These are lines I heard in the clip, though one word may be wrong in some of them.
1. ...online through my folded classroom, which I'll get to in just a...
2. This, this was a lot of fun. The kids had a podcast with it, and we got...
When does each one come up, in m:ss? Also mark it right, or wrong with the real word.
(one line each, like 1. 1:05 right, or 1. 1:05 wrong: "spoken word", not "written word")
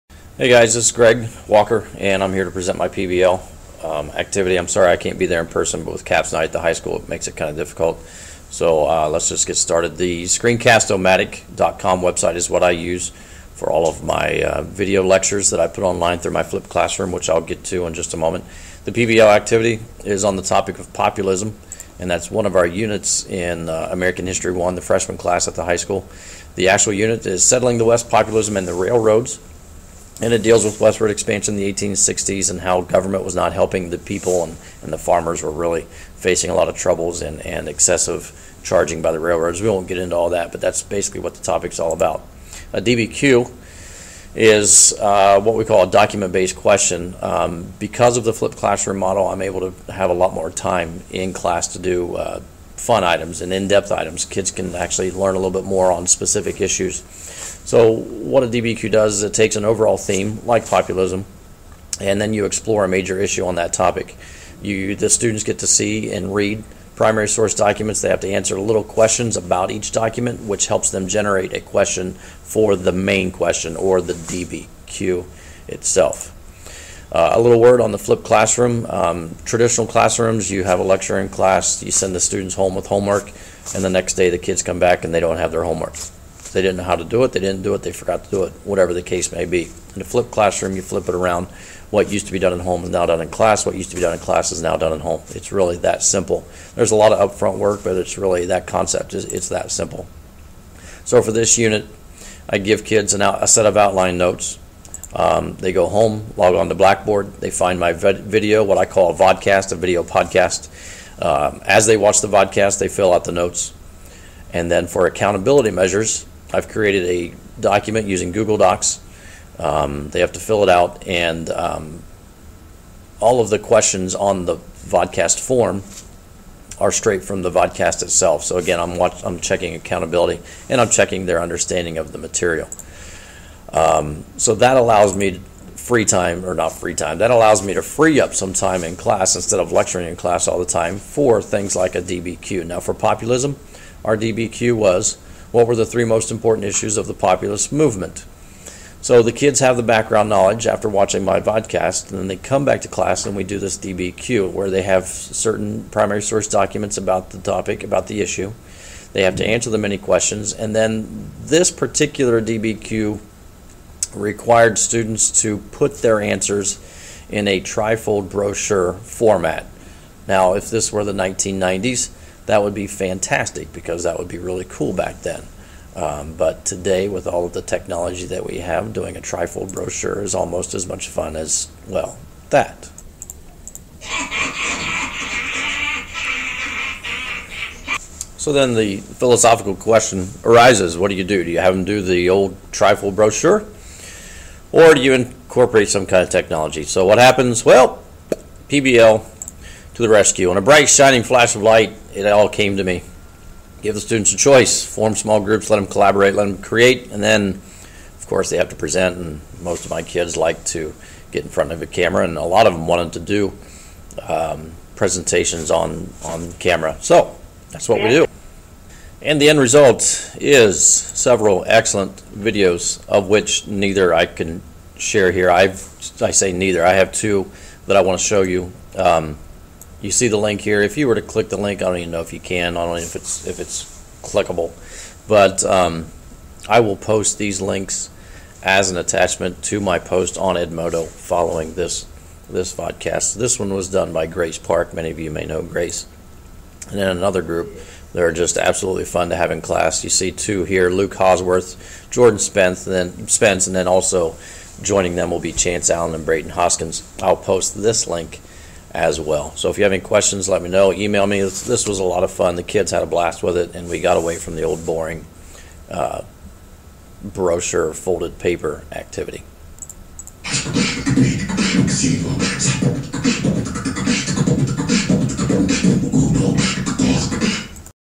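1. 0:15 wrong: "flipped", not "folded"
2. 4:21 wrong: "blast", not "podcast".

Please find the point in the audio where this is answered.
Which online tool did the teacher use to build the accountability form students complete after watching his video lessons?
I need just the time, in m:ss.
1:58.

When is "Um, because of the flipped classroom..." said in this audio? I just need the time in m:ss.
0:47.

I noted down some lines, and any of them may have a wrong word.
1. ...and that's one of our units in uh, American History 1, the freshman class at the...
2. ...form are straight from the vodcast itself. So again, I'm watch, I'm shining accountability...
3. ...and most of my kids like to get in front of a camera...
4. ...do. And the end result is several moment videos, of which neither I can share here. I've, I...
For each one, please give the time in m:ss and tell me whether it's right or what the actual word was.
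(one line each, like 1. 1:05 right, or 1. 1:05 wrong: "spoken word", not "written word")
1. 0:21 right
2. 2:05 wrong: "checking", not "shining"
3. 3:29 right
4. 3:38 wrong: "excellent", not "moment".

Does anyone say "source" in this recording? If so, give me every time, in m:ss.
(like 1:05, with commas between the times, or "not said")
1:07, 2:36.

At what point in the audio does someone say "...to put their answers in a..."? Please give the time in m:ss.
2:45.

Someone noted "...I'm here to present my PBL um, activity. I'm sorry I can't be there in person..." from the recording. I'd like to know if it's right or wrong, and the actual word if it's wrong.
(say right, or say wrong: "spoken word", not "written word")
right.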